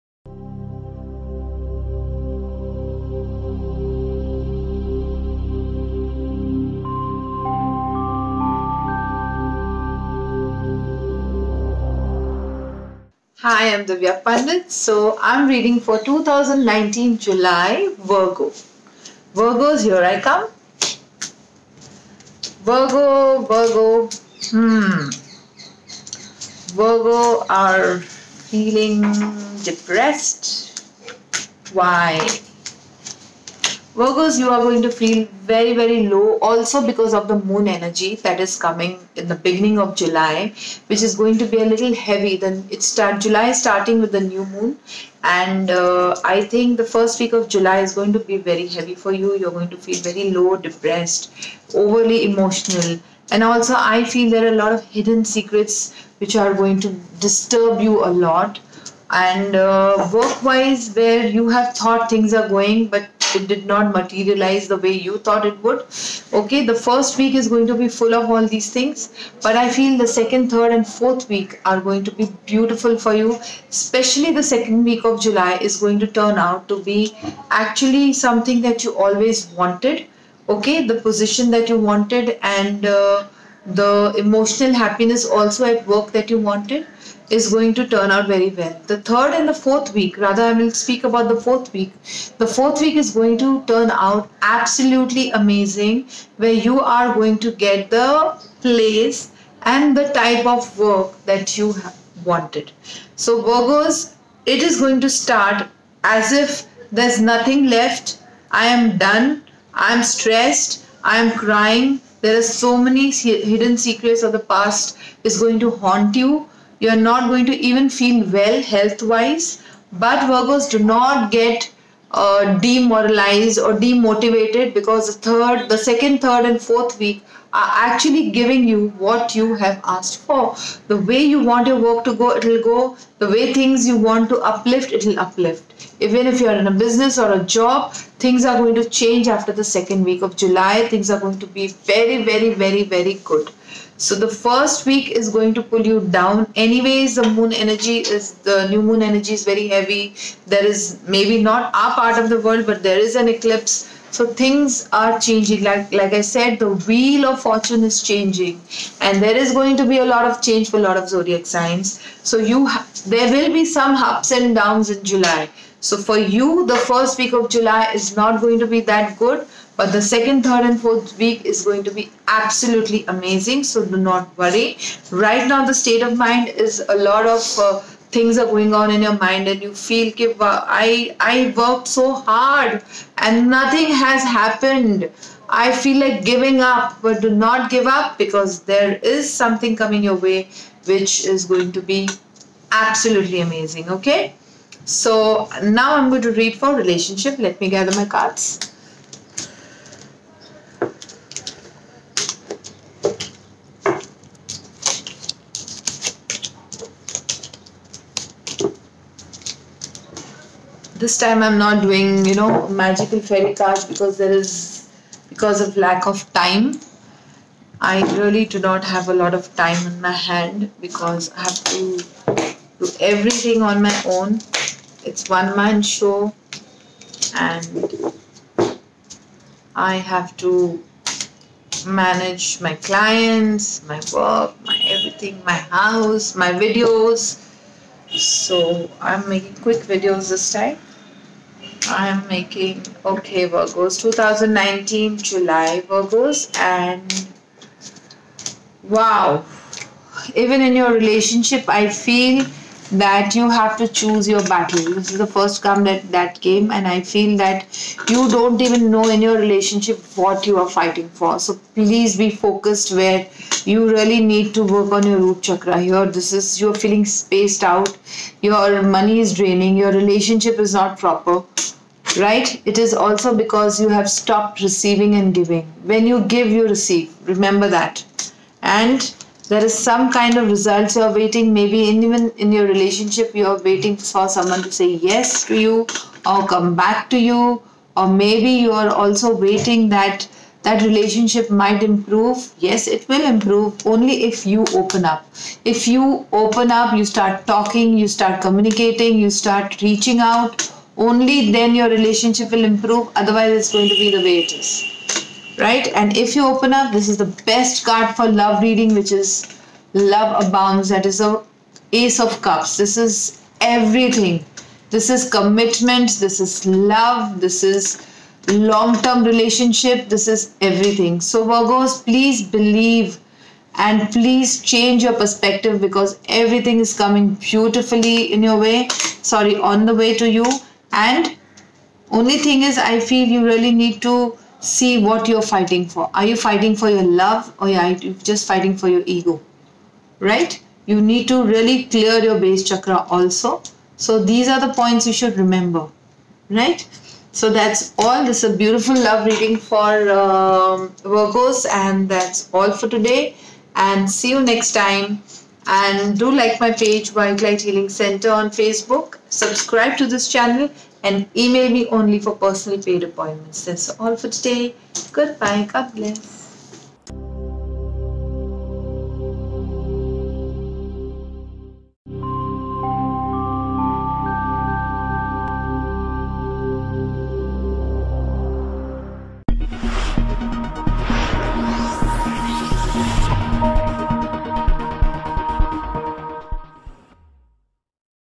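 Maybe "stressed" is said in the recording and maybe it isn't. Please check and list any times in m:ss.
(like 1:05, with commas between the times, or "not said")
1:50.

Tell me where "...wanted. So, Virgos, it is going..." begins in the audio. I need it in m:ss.
1:42.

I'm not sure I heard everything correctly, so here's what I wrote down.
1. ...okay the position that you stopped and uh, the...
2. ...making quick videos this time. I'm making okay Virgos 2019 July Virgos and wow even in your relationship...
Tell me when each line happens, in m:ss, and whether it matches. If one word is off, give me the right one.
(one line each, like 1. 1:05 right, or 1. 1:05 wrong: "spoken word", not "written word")
1. 1:20 wrong: "wanted", not "stopped"
2. 3:59 right.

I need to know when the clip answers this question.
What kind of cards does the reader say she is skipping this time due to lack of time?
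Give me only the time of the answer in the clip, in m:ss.
3:32.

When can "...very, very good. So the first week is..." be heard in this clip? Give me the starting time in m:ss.
2:22.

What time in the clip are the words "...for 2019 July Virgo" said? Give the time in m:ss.
0:15.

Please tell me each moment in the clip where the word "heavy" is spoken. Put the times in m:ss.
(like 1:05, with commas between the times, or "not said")
0:41, 0:48, 2:29.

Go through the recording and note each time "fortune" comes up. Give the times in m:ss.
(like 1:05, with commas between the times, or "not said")
2:37.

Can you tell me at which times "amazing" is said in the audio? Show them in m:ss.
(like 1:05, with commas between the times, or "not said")
1:35, 2:53, 3:13.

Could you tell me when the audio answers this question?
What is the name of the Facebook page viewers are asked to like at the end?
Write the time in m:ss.
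5:57.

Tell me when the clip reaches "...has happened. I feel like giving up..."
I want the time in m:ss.
3:04.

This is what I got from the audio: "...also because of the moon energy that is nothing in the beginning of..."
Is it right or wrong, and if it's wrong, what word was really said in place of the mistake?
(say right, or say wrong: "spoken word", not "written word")
wrong: "coming", not "nothing".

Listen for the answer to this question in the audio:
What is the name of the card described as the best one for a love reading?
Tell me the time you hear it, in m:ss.
5:09.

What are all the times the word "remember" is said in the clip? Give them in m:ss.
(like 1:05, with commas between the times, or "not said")
4:37, 5:45.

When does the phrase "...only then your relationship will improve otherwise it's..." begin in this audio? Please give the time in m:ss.
5:01.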